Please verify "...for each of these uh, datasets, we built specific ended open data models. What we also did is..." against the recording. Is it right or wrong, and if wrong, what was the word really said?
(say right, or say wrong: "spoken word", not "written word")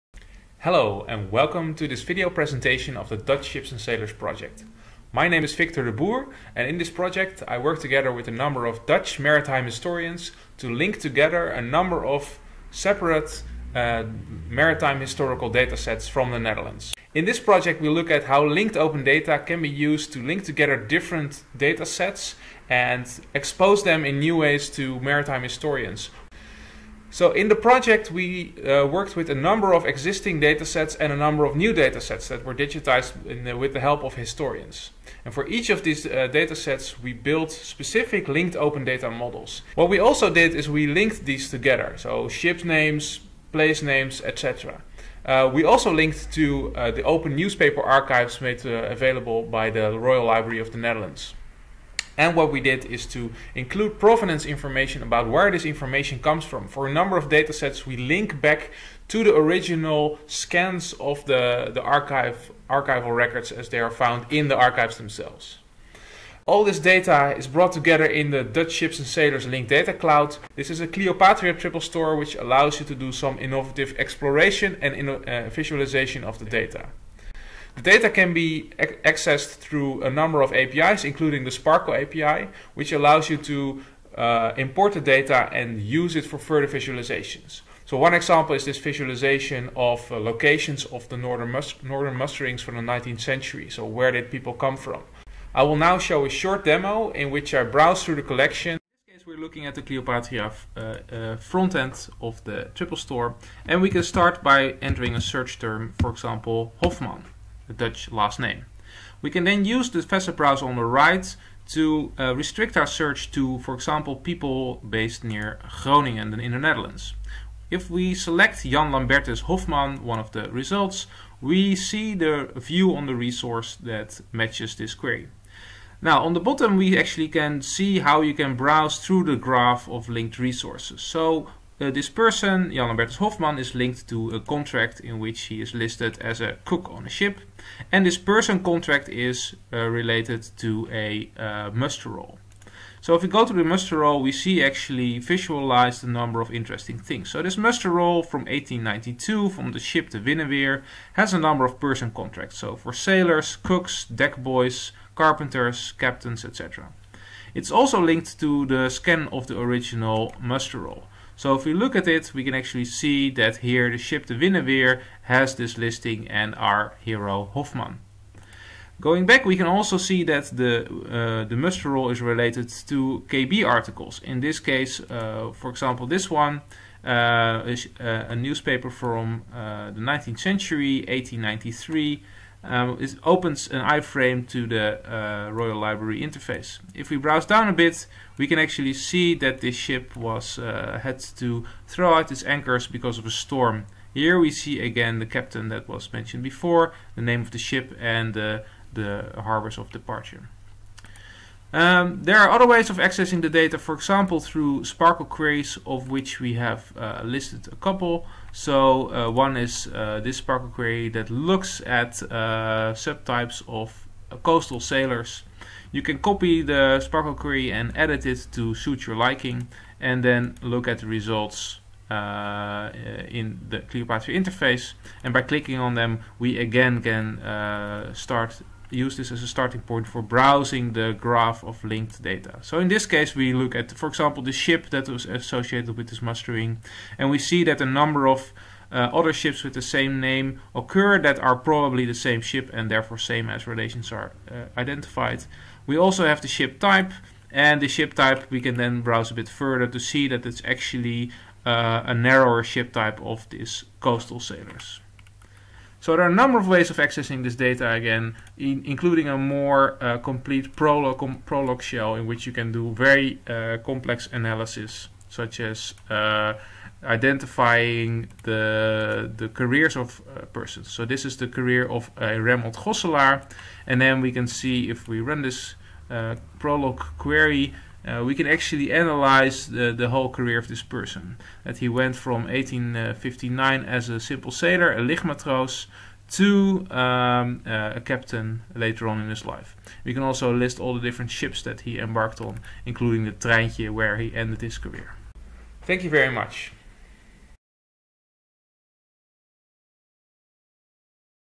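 wrong: "linked", not "ended".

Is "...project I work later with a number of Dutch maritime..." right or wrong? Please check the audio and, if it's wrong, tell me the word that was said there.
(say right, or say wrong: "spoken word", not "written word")
wrong: "together", not "later".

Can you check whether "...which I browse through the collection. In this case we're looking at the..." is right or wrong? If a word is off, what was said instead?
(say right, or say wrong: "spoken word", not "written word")
right.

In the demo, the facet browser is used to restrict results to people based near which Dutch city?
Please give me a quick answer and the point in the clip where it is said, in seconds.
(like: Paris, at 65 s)
Groningen, at 115 s.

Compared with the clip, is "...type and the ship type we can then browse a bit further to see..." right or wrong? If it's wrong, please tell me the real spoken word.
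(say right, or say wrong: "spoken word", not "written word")
right.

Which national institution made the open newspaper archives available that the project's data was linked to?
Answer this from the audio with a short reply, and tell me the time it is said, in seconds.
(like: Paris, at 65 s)
Royal Library of the Netherlands, at 49 s.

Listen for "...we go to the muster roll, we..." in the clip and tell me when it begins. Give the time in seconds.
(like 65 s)
143 s.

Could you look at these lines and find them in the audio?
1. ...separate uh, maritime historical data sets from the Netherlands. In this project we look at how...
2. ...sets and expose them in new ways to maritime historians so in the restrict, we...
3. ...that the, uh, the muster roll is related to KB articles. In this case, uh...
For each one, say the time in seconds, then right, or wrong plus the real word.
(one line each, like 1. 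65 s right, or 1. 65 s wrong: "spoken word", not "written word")
1. 12 s right
2. 21 s wrong: "project", not "restrict"
3. 170 s right.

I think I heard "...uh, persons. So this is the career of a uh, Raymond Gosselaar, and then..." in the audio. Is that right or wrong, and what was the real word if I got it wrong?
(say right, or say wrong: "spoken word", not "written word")
right.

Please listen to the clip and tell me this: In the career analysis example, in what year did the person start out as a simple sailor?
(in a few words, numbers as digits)
1859.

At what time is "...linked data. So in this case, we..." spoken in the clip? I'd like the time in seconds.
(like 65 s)
231 s.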